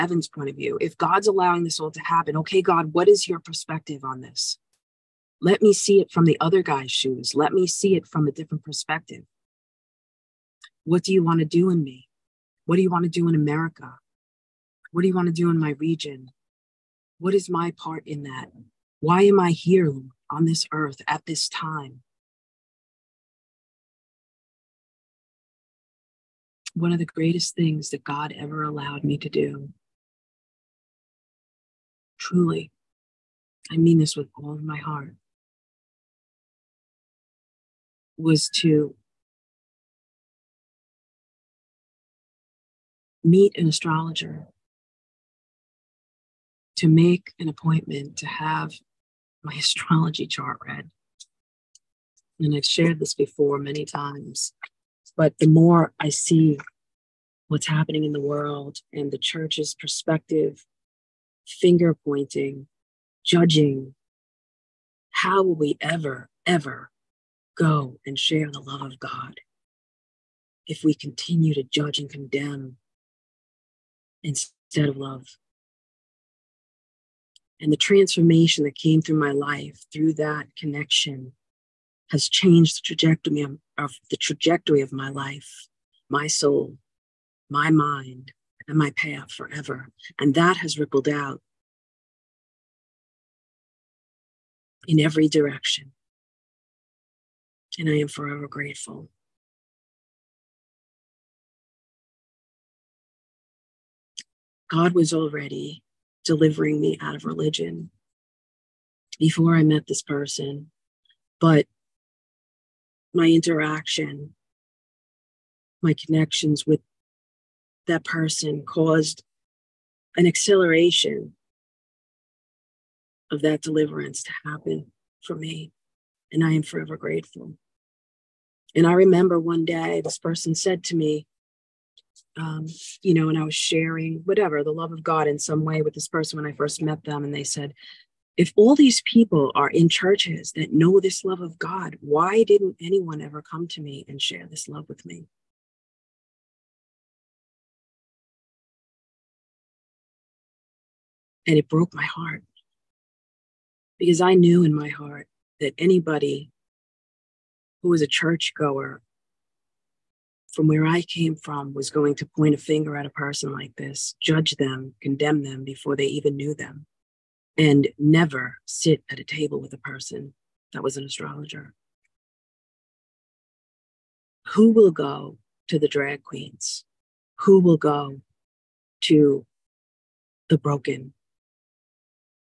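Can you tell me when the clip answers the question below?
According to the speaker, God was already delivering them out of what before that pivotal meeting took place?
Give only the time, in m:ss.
1:47.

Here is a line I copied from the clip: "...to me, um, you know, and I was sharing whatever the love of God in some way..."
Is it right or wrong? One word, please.
right.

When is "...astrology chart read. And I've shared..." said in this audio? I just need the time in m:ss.
0:49.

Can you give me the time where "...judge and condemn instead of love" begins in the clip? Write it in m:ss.
1:11.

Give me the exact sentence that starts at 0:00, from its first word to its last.
If God's allowing this all to happen, okay, God, what is your perspective on this?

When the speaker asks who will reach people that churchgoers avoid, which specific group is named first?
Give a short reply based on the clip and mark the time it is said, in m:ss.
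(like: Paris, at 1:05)
drag queens, at 2:55.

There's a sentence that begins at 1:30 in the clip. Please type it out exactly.
And that has rippled out in every direction.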